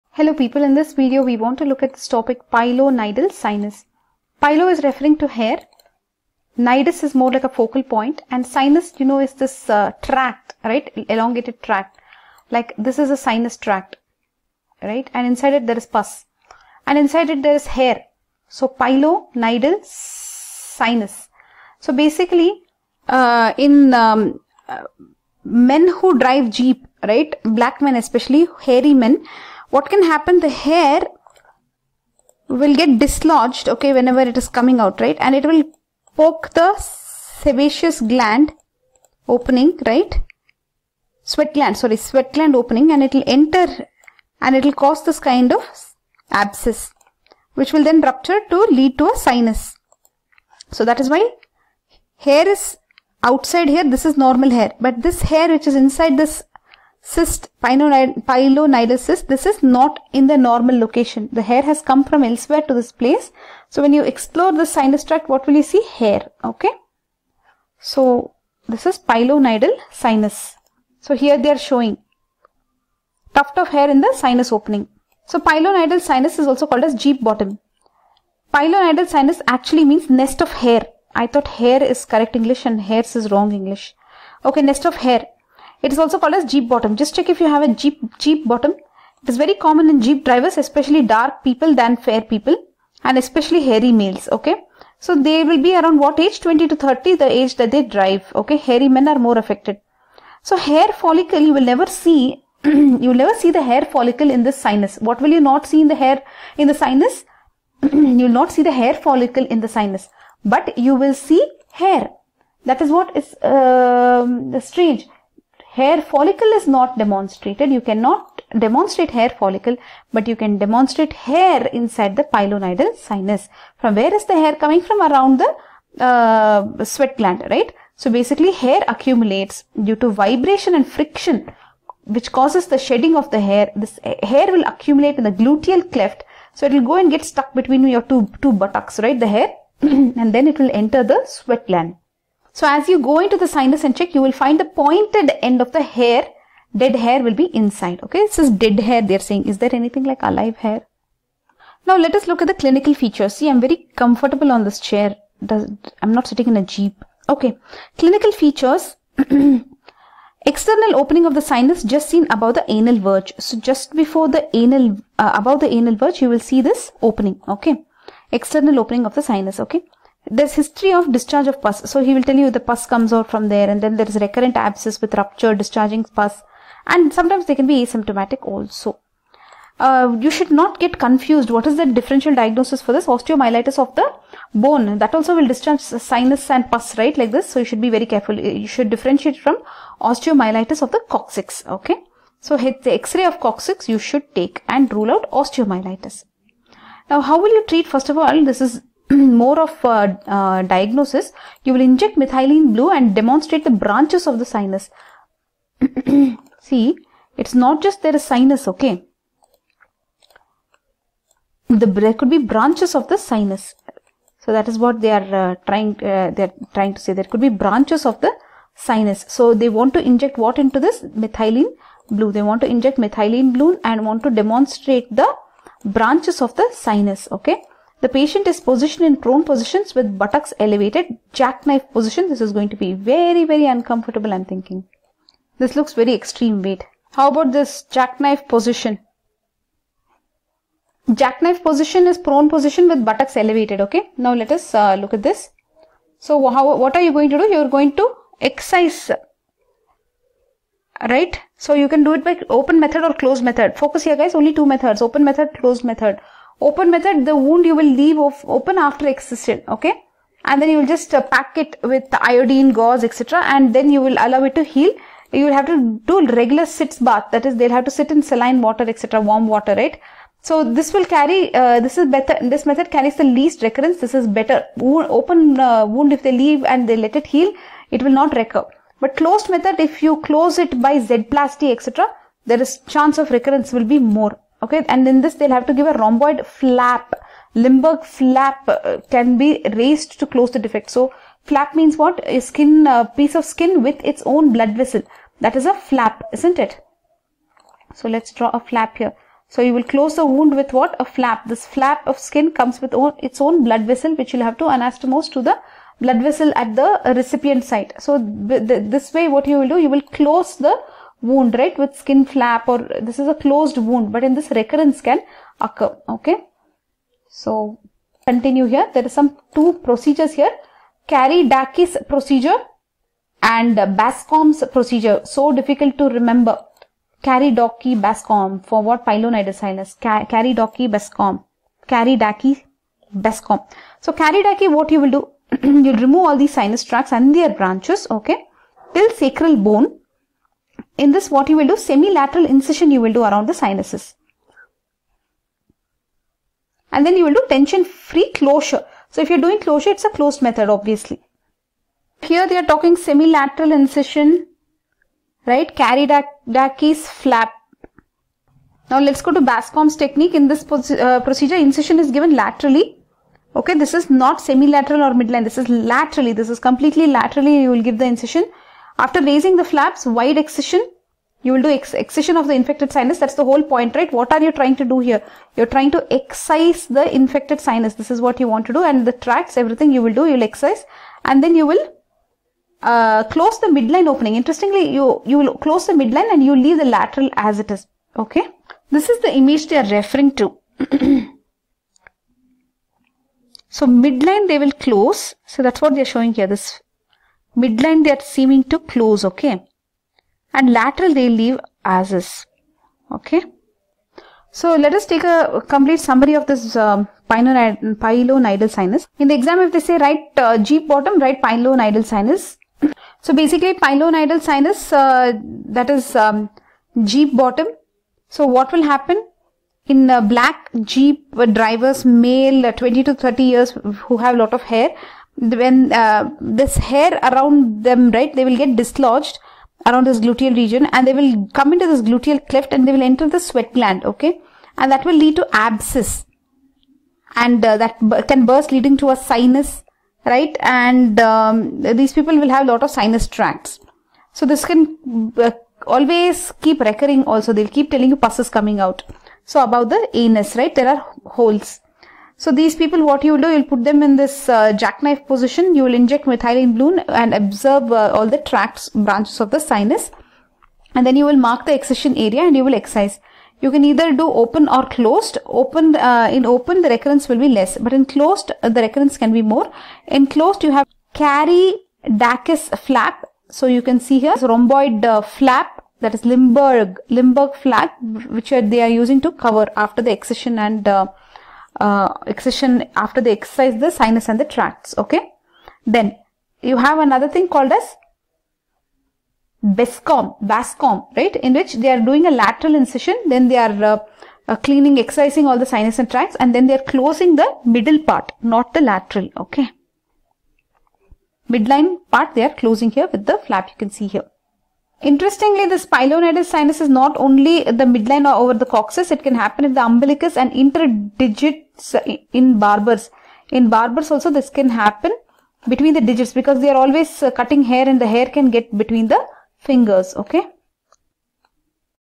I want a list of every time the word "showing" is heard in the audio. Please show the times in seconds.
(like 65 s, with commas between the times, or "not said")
71 s, 396 s.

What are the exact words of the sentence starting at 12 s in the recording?
Like this is a sinus tract, right and inside it there is pus and inside it there is hair.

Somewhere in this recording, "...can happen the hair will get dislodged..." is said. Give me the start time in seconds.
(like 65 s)
29 s.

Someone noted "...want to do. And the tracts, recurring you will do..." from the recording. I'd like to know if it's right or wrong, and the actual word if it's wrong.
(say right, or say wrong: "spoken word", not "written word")
wrong: "everything", not "recurring".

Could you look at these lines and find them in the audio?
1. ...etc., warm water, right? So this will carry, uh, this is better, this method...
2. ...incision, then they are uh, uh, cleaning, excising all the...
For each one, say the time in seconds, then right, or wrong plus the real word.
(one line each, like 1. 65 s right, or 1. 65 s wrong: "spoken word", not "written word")
1. 268 s right
2. 492 s right.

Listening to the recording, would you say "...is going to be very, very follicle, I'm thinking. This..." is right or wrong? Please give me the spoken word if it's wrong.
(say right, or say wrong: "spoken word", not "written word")
wrong: "uncomfortable", not "follicle".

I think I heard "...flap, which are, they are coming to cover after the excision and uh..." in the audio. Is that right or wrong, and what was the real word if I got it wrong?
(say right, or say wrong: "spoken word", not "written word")
wrong: "using", not "coming".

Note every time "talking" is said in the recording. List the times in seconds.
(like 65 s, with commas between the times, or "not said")
352 s.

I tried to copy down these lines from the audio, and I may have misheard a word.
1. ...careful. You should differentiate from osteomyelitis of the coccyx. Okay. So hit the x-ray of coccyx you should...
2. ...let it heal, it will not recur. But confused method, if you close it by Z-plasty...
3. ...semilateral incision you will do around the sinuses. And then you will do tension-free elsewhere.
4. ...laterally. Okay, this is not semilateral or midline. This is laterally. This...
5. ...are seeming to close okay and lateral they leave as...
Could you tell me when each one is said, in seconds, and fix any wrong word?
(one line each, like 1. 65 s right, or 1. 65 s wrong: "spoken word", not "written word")
1. 188 s right
2. 276 s wrong: "closed", not "confused"
3. 341 s wrong: "closure", not "elsewhere"
4. 362 s right
5. 398 s right.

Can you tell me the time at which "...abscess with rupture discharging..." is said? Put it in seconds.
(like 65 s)
174 s.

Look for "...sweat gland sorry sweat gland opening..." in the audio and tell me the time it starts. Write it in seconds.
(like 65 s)
41 s.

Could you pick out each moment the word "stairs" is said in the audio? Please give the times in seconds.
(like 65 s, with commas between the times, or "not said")
not said.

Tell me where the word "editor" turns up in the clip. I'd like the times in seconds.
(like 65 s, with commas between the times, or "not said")
not said.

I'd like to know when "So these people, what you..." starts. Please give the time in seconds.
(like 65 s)
452 s.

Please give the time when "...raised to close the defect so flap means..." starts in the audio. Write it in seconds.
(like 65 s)
289 s.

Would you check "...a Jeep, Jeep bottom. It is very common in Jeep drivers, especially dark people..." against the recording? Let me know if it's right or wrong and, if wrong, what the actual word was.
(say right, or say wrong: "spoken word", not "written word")
right.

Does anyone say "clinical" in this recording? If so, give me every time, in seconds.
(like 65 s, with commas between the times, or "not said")
152 s, 157 s.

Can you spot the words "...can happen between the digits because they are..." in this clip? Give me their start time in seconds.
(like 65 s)
514 s.